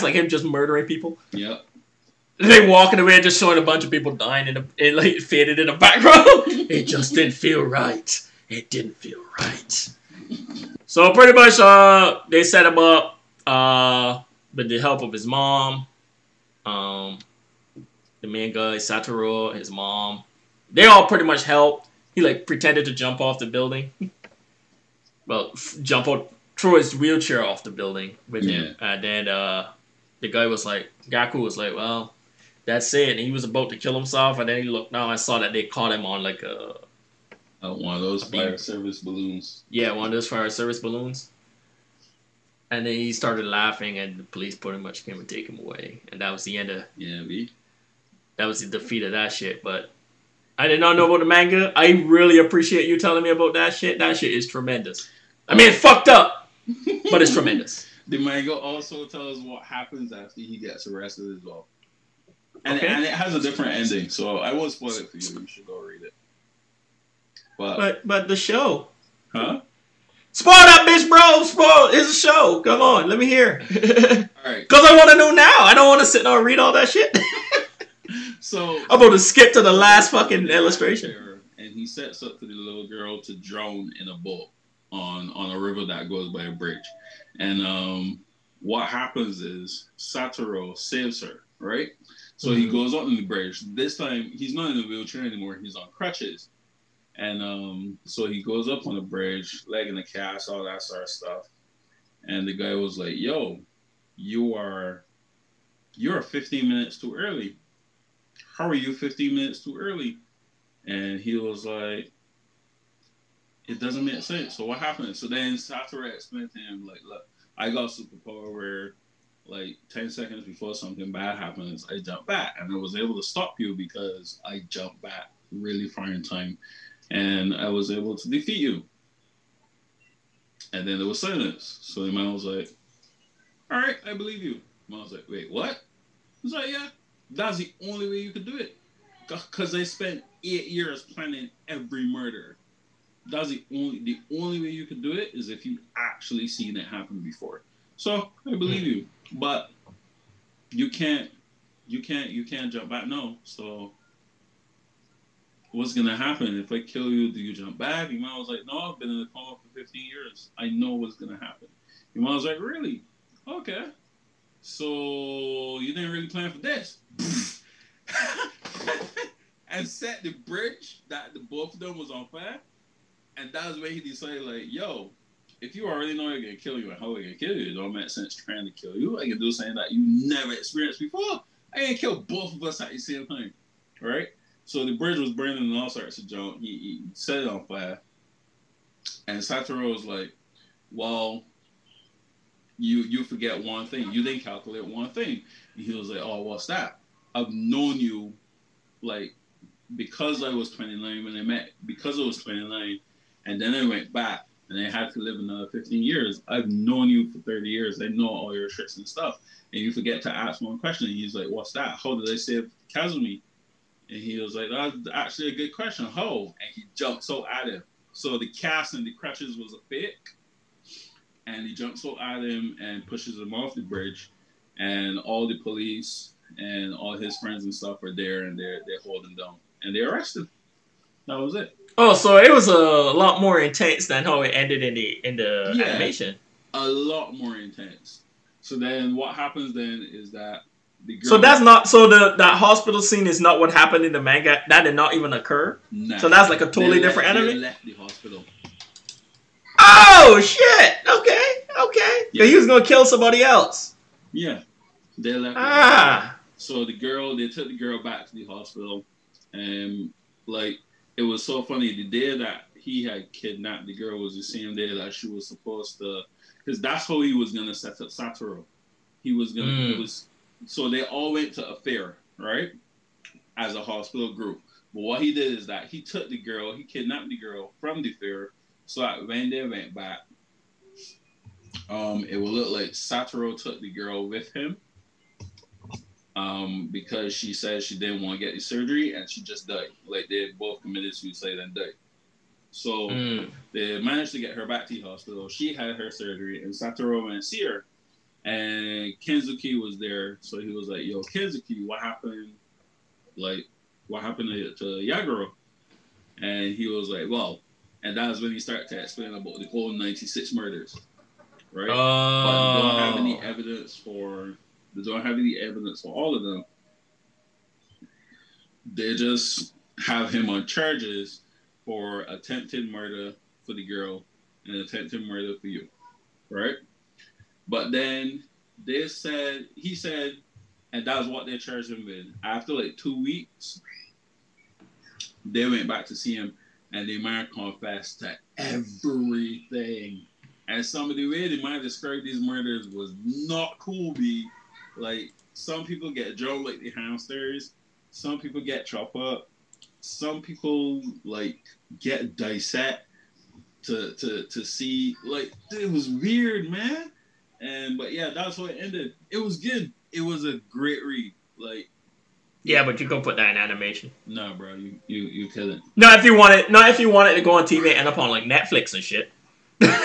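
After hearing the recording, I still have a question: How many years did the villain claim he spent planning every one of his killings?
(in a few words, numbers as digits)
8.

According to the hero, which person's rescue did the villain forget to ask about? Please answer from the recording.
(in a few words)
Kazumi.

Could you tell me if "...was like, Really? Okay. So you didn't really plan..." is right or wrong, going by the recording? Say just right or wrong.
right.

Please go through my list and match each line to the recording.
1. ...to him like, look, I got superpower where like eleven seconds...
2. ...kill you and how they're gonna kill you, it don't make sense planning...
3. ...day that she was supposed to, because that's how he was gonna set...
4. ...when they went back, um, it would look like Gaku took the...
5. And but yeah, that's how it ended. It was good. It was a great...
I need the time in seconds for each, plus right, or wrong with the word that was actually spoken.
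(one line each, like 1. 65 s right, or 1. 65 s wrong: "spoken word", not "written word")
1. 116 s wrong: "ten", not "eleven"
2. 176 s wrong: "trying", not "planning"
3. 264 s right
4. 279 s wrong: "Satoru", not "Gaku"
5. 357 s right.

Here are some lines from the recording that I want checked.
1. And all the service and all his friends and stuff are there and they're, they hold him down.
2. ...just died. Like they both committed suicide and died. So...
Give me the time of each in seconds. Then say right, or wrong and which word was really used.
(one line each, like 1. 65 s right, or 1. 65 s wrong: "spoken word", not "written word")
1. 224 s wrong: "police", not "service"
2. 289 s right.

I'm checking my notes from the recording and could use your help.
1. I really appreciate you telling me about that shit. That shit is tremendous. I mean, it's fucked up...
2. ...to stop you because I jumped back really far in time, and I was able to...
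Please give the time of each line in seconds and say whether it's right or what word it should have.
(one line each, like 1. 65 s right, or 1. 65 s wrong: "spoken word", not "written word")
1. 51 s right
2. 123 s right.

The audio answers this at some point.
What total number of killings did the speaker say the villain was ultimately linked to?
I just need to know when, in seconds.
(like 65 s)
309 s.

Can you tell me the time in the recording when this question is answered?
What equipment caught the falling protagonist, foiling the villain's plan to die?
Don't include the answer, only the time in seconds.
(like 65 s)
40 s.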